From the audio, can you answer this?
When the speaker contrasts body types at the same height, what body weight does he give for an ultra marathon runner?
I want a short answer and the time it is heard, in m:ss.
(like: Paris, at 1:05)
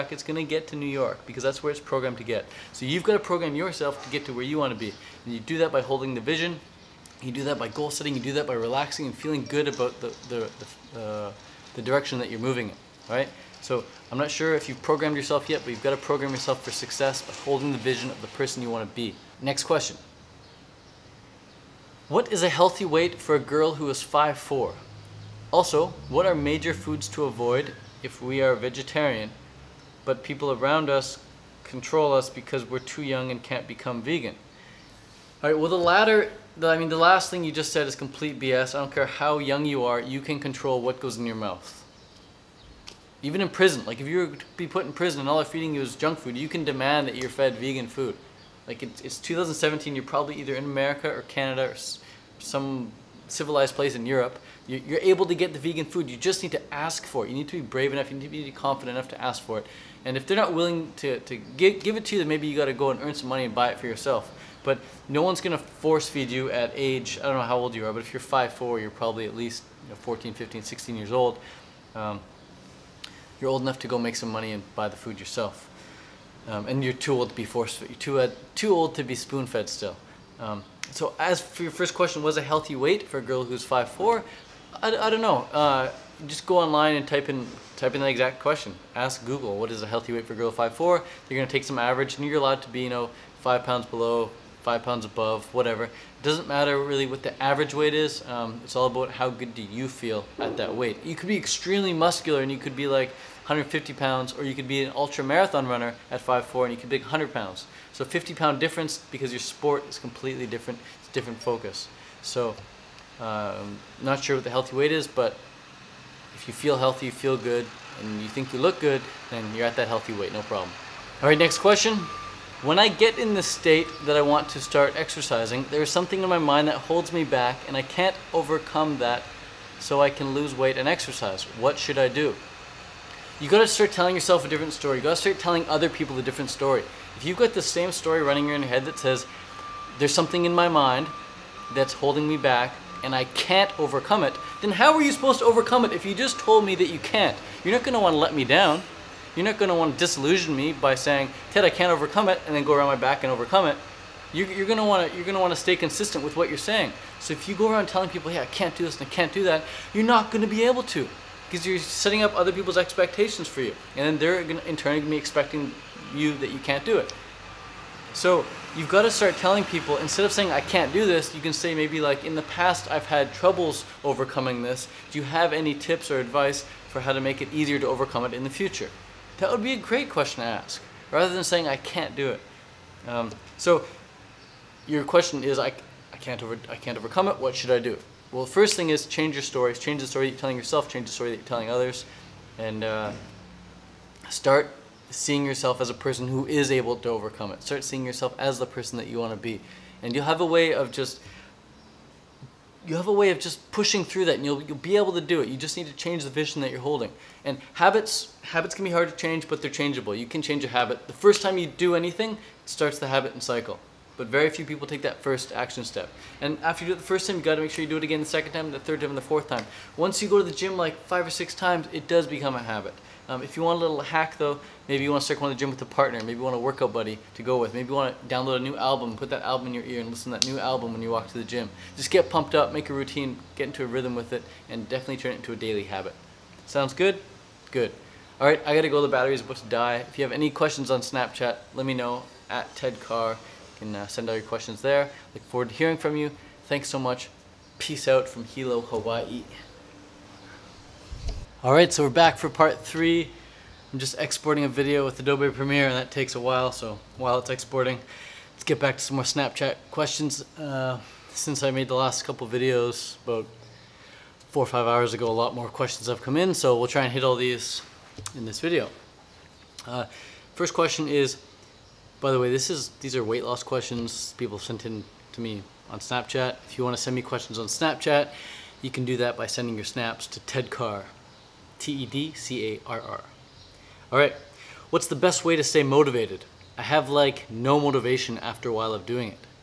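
100 pounds, at 1:46.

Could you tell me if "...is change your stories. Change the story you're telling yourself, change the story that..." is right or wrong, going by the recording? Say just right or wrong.
right.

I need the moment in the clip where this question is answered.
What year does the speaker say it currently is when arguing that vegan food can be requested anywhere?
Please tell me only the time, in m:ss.
0:49.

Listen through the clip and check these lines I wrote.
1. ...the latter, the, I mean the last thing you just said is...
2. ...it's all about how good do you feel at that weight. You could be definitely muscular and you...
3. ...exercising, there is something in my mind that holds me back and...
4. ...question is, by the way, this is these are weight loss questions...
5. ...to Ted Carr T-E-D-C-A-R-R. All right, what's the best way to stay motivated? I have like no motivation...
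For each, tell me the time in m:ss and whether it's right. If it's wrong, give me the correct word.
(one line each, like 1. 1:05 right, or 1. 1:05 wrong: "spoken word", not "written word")
1. 0:35 right
2. 1:38 wrong: "extremely", not "definitely"
3. 2:04 right
4. 4:30 right
5. 4:40 right.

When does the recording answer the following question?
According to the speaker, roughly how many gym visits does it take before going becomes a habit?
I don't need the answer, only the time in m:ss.
3:41.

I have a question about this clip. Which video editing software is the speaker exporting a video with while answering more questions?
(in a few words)
Adobe Premiere.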